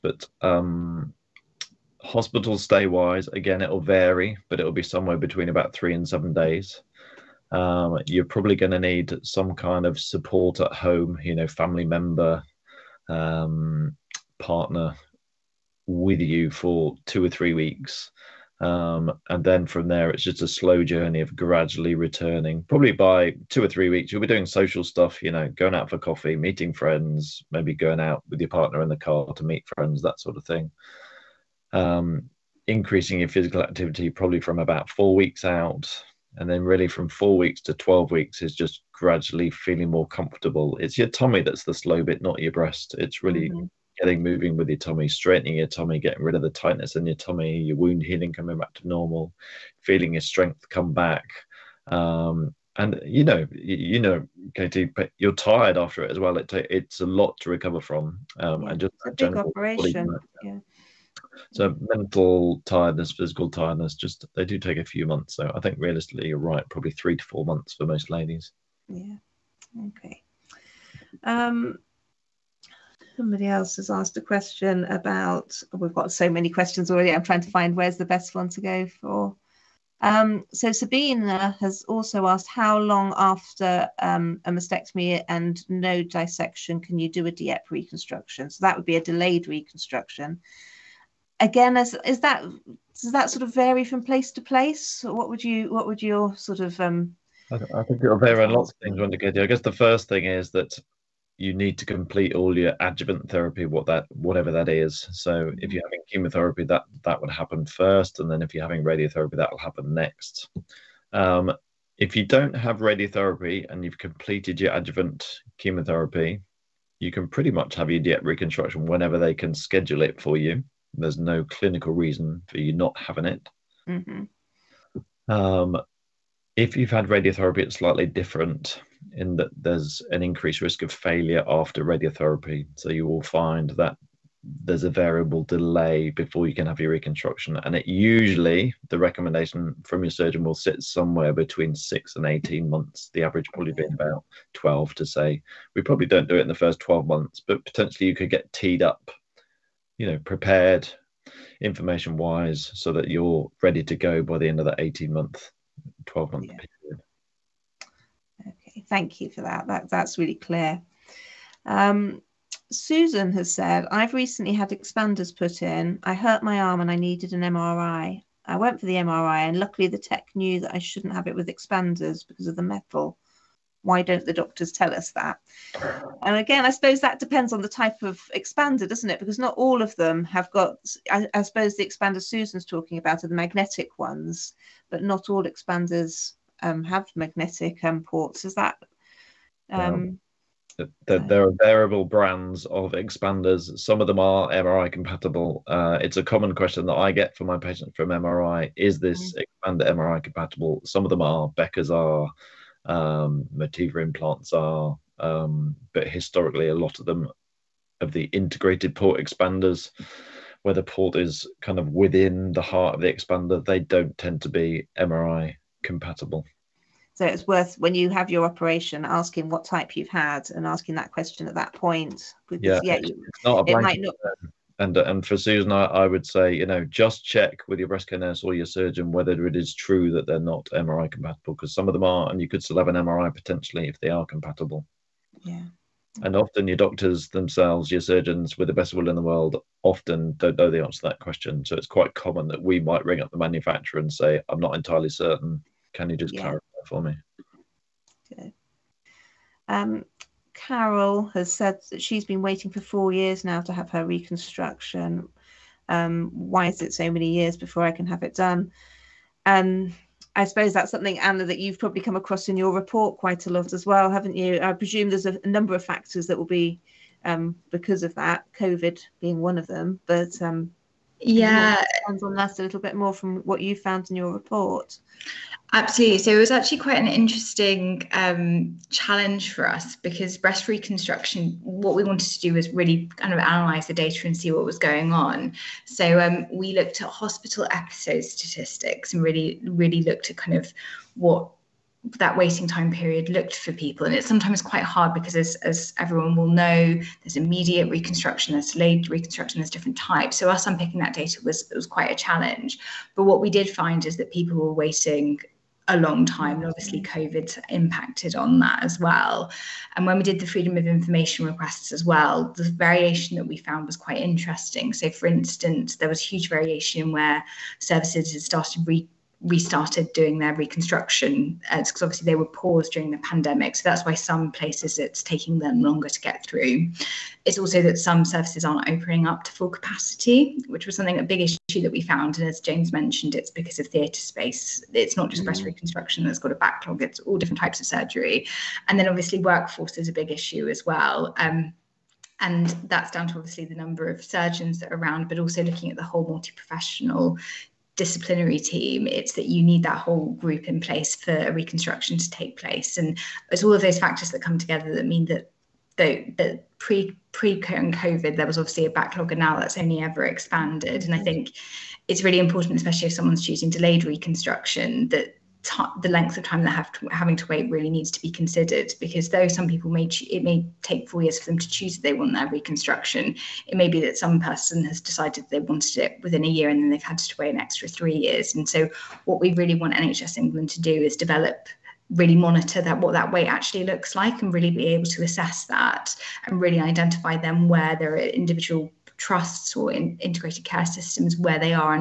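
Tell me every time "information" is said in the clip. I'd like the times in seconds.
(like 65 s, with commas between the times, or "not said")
151 s, 310 s.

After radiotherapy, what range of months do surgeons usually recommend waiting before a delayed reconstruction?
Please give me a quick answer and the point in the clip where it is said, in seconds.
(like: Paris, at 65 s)
6 to 18 months, at 141 s.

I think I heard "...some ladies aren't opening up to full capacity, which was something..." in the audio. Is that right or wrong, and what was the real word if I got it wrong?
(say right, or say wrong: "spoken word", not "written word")
wrong: "services", not "ladies".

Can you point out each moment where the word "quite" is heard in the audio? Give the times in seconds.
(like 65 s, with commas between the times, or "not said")
241 s, 263 s, 276 s, 294 s, 301 s, 313 s.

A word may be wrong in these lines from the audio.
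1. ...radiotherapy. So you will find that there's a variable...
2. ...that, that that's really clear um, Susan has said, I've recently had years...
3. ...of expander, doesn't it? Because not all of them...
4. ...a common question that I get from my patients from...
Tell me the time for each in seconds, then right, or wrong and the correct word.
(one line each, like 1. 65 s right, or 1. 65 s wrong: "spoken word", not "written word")
1. 131 s right
2. 159 s wrong: "expanders", not "years"
3. 178 s right
4. 196 s right.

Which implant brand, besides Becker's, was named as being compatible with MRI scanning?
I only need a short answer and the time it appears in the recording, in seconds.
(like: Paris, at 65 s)
Motiva, at 203 s.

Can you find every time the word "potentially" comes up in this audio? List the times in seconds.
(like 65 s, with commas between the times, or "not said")
147 s, 233 s.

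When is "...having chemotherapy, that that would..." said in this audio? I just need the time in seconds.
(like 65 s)
105 s.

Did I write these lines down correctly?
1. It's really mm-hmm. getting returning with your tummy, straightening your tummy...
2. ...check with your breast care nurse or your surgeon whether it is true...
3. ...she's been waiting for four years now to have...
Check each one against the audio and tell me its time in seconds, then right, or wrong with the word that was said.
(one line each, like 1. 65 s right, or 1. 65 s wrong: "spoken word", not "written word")
1. 42 s wrong: "moving", not "returning"
2. 227 s right
3. 252 s right.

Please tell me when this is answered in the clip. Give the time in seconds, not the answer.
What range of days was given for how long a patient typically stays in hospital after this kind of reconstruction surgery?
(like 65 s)
5 s.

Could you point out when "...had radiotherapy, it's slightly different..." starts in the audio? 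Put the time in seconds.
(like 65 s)
126 s.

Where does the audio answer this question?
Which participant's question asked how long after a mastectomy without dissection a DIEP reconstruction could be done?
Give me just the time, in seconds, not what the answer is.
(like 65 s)
80 s.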